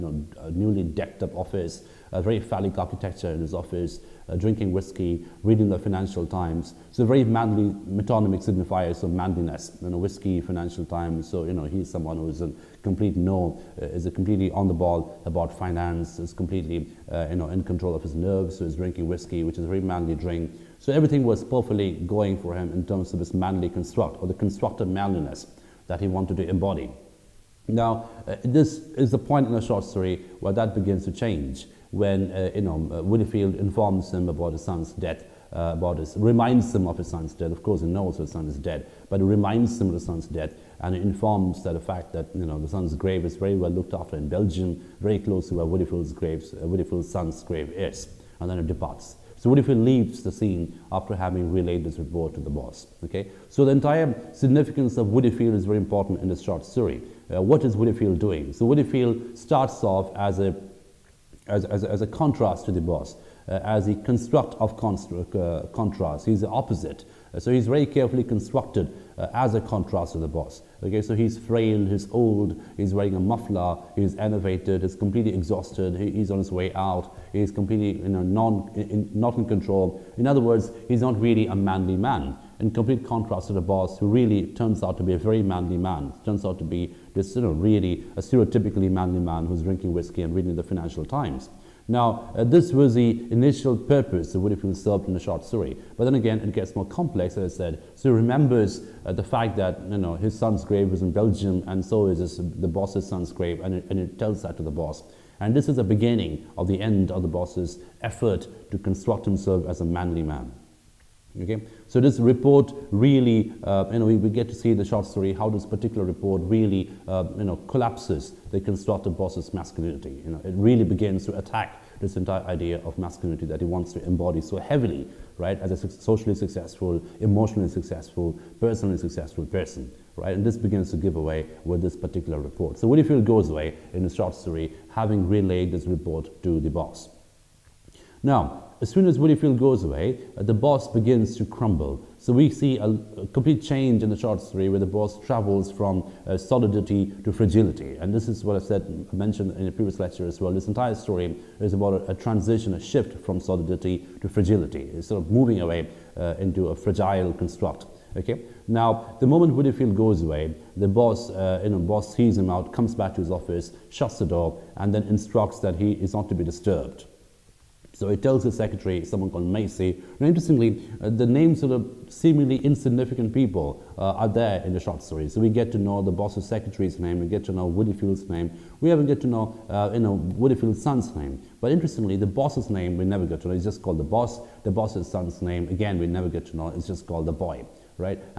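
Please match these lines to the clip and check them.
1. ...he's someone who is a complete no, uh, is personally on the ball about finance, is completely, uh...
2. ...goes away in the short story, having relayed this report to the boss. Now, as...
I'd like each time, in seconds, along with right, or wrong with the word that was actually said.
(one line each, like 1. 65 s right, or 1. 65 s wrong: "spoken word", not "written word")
1. 11 s wrong: "completely", not "personally"
2. 133 s right.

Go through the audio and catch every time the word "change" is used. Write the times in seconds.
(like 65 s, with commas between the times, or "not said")
31 s, 143 s.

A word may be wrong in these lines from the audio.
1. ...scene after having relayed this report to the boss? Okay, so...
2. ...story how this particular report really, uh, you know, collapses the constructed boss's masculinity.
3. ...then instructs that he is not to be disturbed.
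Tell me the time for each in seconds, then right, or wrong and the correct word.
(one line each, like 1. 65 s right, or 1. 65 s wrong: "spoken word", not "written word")
1. 50 s right
2. 115 s right
3. 164 s right.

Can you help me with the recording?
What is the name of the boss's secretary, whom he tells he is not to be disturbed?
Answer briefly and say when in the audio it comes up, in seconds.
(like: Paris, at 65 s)
Macey, at 169 s.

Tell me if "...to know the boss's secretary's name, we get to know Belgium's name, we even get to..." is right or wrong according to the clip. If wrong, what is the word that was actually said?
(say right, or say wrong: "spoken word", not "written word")
wrong: "Woodifield", not "Belgium".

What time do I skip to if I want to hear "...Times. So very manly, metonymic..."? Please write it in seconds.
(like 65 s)
6 s.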